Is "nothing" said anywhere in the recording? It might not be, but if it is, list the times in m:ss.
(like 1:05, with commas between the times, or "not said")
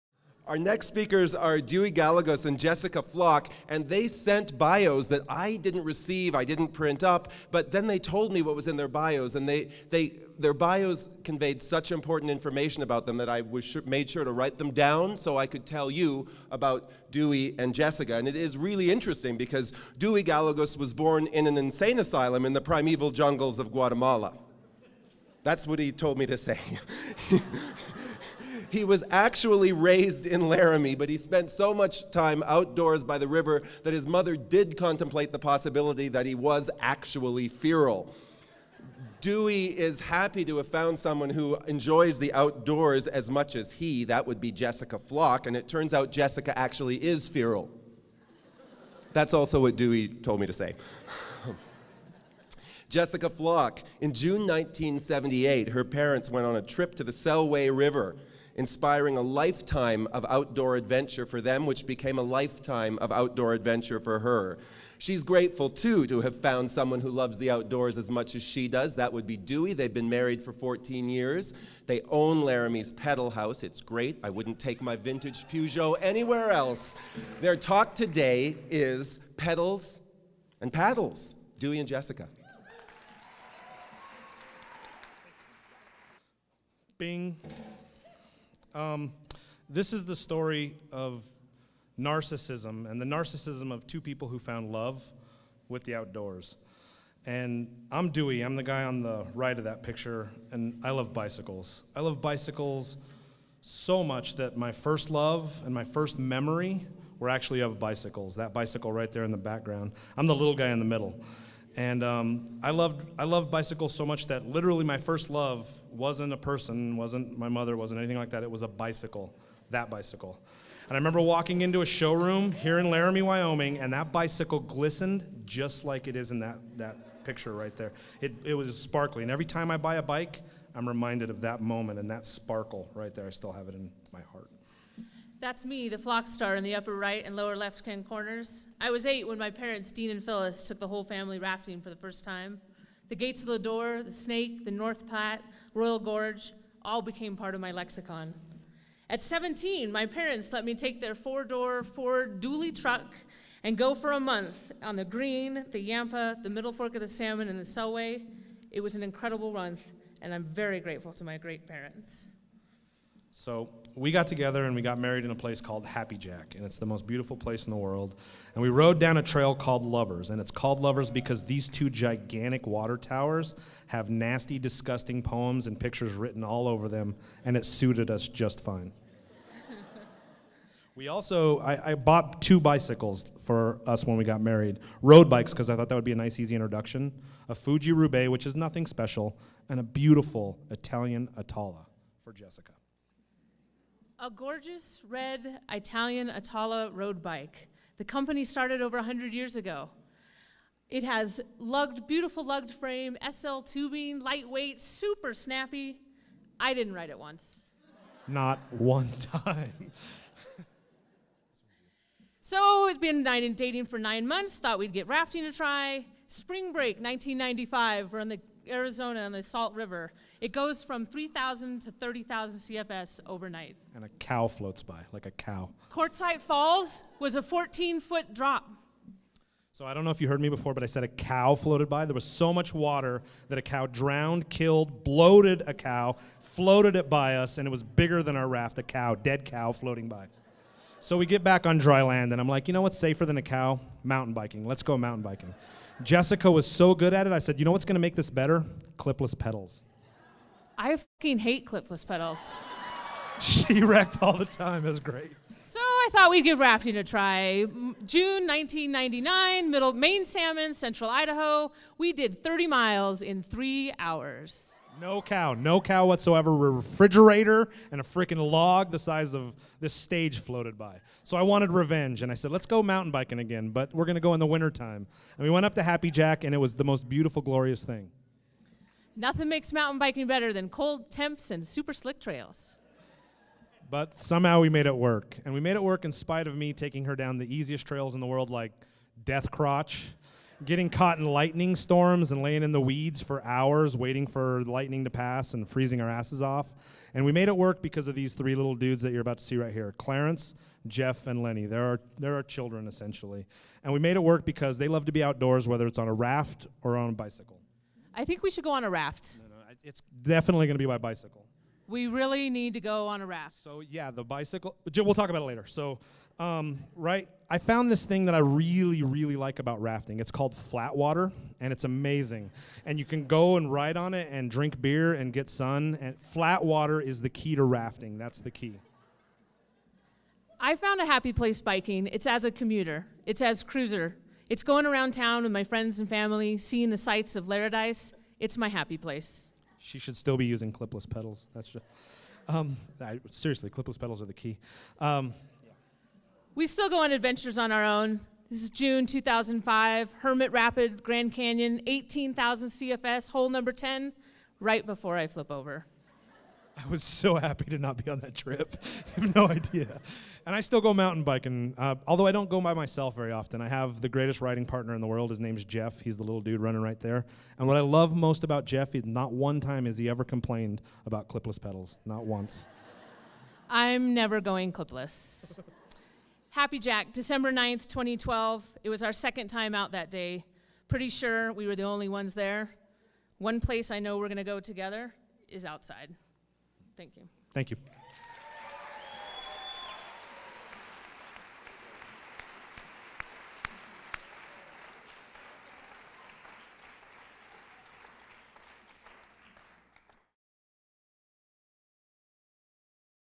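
3:08, 4:39.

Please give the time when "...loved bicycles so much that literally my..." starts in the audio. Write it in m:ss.
1:53.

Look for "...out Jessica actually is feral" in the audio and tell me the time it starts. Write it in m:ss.
0:45.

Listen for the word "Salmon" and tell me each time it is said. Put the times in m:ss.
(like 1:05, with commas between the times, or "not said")
2:37, 4:20.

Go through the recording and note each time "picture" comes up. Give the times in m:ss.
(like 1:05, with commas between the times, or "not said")
1:39, 2:07, 2:55.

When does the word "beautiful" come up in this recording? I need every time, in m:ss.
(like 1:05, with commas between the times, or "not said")
2:47, 3:09, 3:22, 4:37.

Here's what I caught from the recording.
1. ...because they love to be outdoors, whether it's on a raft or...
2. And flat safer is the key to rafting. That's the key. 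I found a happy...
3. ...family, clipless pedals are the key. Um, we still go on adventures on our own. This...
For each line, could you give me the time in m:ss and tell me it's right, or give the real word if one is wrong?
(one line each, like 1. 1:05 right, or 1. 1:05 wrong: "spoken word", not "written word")
1. 5:04 right
2. 5:26 wrong: "water", not "safer"
3. 5:43 wrong: "seriously", not "family".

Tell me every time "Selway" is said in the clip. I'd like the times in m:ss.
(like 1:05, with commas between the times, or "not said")
0:57, 2:37.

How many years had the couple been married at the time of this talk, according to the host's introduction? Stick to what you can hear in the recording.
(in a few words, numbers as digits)
14.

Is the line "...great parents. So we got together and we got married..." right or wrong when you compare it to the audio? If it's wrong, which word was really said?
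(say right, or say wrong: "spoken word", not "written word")
right.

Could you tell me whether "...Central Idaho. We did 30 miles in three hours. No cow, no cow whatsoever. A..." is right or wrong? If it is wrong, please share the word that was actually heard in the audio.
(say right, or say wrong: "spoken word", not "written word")
right.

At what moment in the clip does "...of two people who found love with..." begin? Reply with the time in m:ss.
1:33.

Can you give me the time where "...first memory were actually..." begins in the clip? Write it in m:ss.
1:45.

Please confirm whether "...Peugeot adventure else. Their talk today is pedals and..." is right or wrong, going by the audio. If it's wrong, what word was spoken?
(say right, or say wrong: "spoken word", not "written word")
wrong: "anywhere", not "adventure".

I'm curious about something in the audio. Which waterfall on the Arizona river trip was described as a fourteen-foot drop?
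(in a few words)
Quartzite Falls.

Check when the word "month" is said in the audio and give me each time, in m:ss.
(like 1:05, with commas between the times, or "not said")
2:34, 2:39, 3:34.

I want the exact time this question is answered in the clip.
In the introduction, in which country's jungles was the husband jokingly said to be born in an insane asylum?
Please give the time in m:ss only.
0:23.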